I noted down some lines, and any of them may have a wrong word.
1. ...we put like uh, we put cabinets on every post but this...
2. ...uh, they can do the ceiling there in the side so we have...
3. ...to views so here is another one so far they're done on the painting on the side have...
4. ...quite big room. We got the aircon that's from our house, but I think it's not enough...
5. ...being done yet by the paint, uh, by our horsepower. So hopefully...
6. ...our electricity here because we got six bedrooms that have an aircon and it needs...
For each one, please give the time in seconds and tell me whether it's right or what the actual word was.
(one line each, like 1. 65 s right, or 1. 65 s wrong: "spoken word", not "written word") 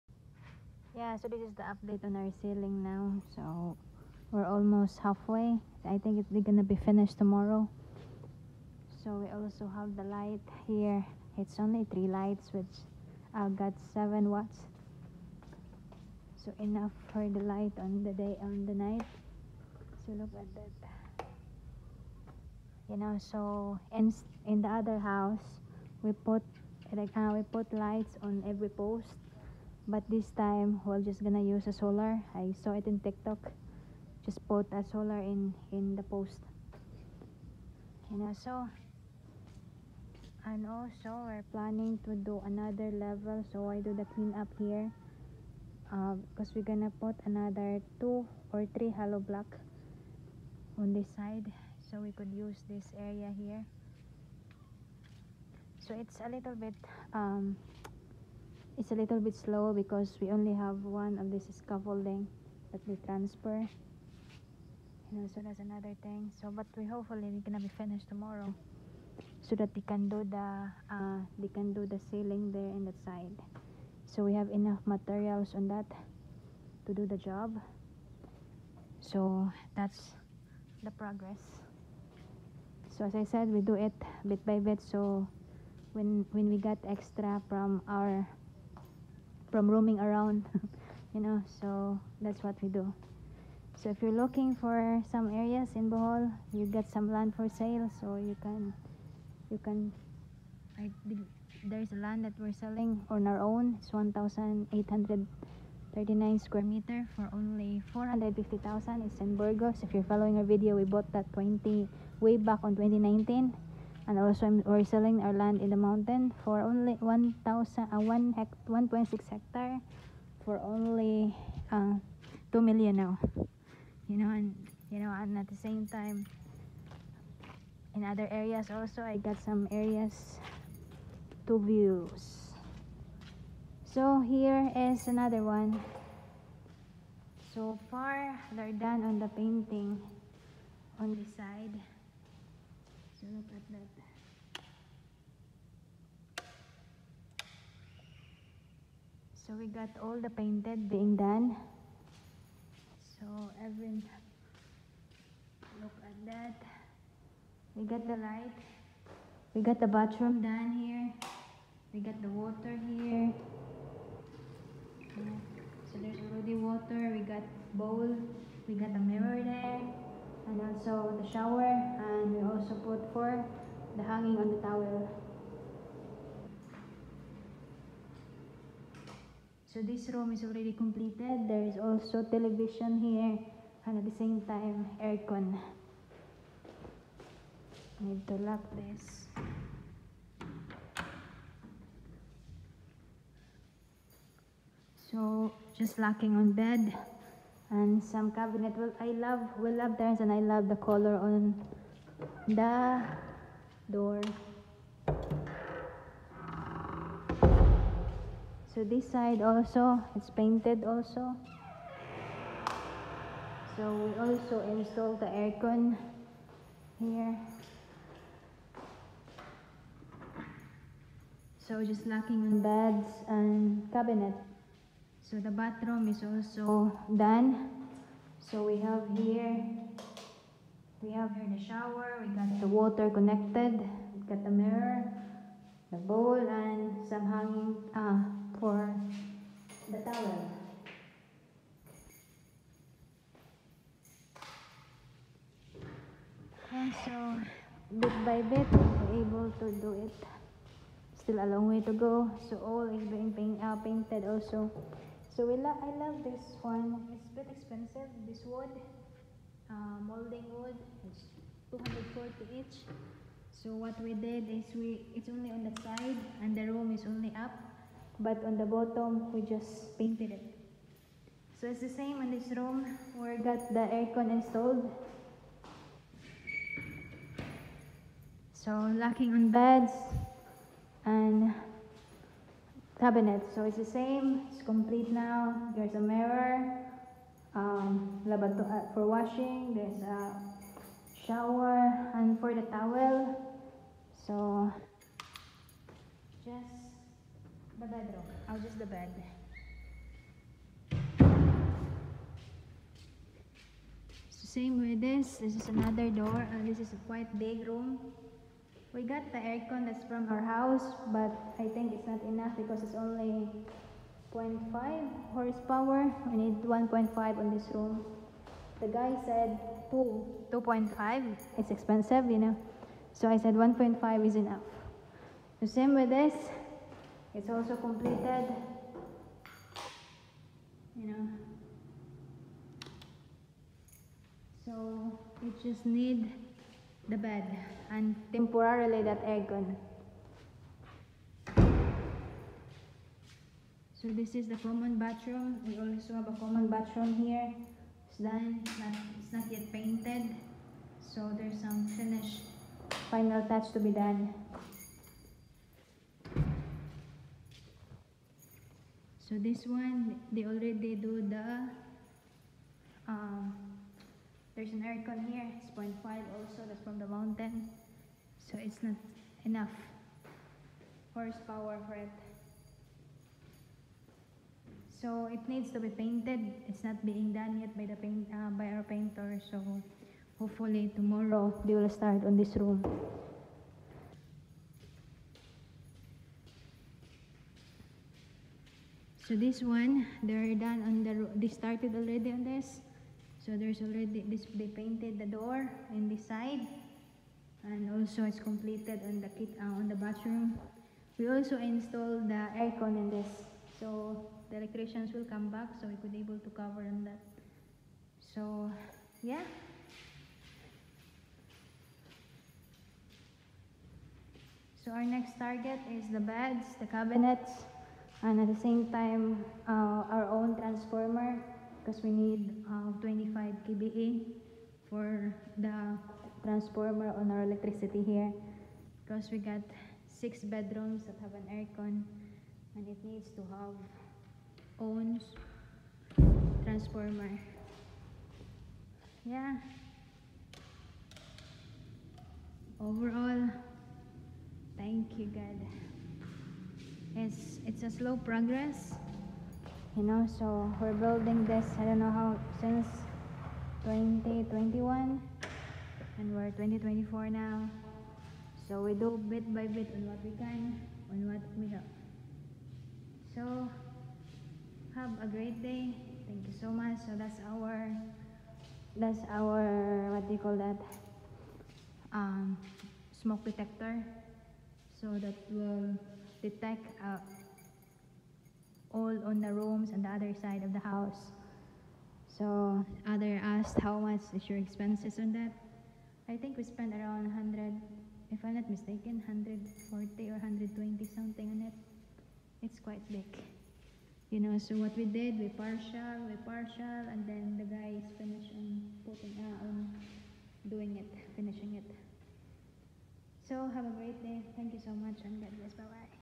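1. 26 s wrong: "lights", not "cabinets"
2. 70 s right
3. 131 s right
4. 307 s right
5. 377 s wrong: "painter", not "horsepower"
6. 427 s right.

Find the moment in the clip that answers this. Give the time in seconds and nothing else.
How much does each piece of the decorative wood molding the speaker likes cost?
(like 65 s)
261 s.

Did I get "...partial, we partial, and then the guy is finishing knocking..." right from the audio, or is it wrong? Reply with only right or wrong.
wrong.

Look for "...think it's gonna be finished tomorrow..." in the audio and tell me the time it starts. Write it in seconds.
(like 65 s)
5 s.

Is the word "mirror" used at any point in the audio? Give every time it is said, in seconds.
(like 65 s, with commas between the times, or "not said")
168 s, 234 s, 286 s.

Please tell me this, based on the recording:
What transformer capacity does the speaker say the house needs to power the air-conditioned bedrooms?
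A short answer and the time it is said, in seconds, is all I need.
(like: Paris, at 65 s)
25 kVA, at 422 s.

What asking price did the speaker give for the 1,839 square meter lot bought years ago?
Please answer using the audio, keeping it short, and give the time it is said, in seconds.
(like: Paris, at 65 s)
450,000, at 107 s.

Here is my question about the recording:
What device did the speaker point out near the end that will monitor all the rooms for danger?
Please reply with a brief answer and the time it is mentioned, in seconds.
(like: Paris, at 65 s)
smoke detector, at 473 s.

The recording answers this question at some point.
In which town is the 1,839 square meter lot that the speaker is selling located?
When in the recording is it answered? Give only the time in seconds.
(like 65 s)
109 s.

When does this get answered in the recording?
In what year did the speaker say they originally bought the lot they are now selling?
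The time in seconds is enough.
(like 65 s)
112 s.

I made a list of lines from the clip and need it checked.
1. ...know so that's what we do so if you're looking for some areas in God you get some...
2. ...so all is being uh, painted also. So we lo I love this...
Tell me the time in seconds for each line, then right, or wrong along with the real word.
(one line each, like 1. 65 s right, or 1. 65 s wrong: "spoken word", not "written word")
1. 91 s wrong: "Bohol", not "God"
2. 252 s right.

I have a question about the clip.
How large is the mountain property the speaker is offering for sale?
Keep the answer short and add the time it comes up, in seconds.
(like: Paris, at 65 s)
1.6 hectares, at 118 s.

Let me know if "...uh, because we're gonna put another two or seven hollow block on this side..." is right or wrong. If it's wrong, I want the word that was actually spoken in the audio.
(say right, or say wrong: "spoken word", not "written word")
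wrong: "three", not "seven".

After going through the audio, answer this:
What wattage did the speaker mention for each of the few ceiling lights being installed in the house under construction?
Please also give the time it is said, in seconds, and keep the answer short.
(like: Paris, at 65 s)
7 watts, at 13 s.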